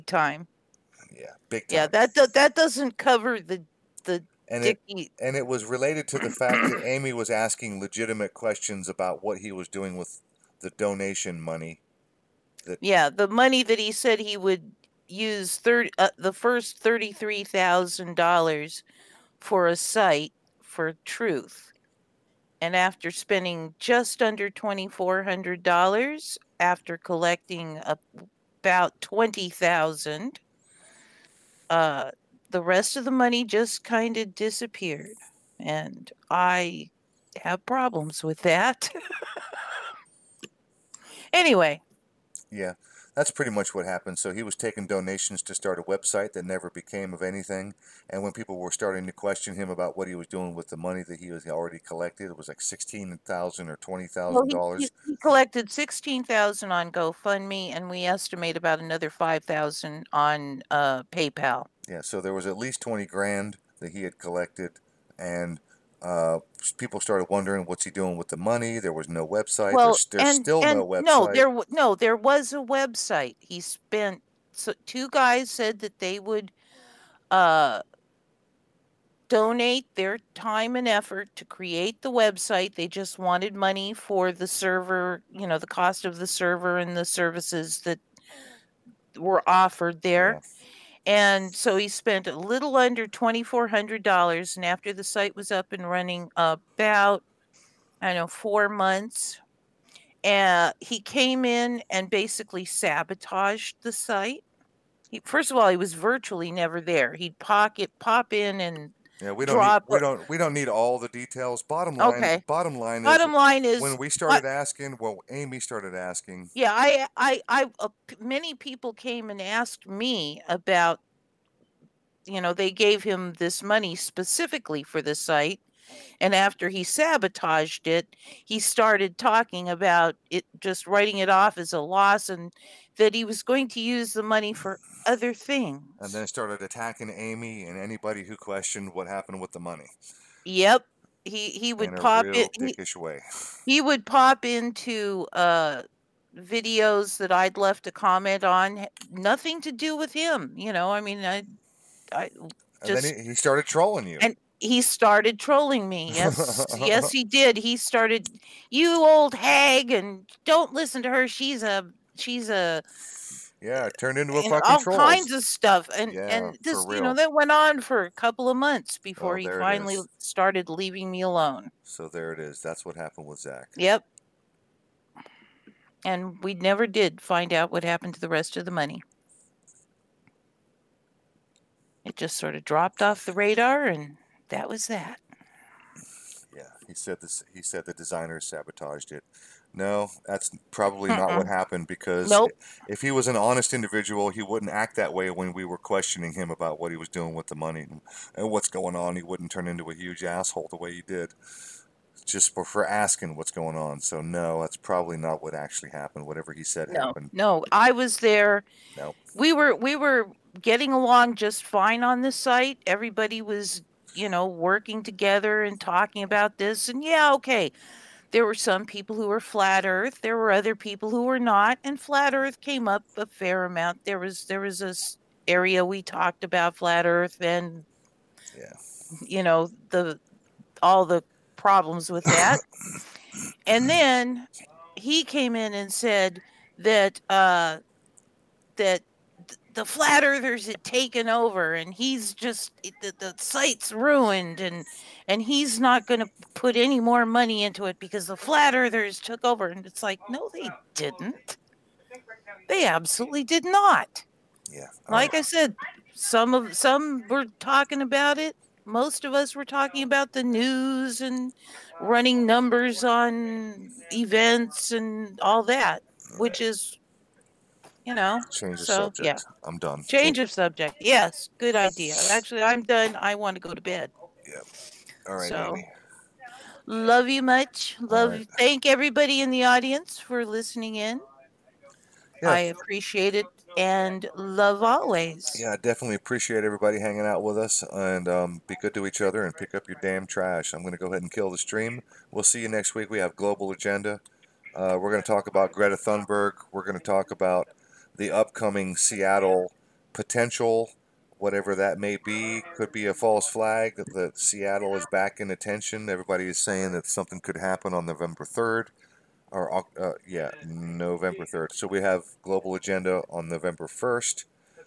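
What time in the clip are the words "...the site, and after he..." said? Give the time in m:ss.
2:05.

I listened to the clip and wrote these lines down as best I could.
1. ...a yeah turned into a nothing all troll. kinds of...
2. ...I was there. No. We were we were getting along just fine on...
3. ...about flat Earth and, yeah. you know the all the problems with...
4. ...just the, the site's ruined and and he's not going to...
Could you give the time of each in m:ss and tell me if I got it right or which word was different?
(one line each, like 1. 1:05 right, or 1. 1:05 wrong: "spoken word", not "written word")
1. 2:42 wrong: "fucking", not "nothing"
2. 3:27 right
3. 3:46 right
4. 4:02 right.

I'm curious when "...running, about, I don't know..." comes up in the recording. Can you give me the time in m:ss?
1:35.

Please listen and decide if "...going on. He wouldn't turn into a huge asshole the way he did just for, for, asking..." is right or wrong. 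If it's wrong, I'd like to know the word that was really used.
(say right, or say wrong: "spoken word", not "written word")
right.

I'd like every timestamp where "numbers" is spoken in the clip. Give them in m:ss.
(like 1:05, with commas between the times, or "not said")
4:22.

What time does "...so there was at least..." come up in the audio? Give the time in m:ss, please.
1:02.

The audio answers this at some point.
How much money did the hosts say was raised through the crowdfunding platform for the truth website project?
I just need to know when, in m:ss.
0:55.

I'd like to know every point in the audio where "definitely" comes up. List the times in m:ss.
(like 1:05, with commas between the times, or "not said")
4:45.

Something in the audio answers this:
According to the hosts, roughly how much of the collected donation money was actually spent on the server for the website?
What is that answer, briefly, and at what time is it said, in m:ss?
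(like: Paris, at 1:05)
just under $2,400, at 0:23.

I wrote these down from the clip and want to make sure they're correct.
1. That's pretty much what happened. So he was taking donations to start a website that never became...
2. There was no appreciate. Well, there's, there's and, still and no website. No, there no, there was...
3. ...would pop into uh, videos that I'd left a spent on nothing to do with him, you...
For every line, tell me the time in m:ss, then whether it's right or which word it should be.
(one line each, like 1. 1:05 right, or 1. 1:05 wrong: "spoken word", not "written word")
1. 0:43 right
2. 1:08 wrong: "website", not "appreciate"
3. 2:23 wrong: "comment", not "spent".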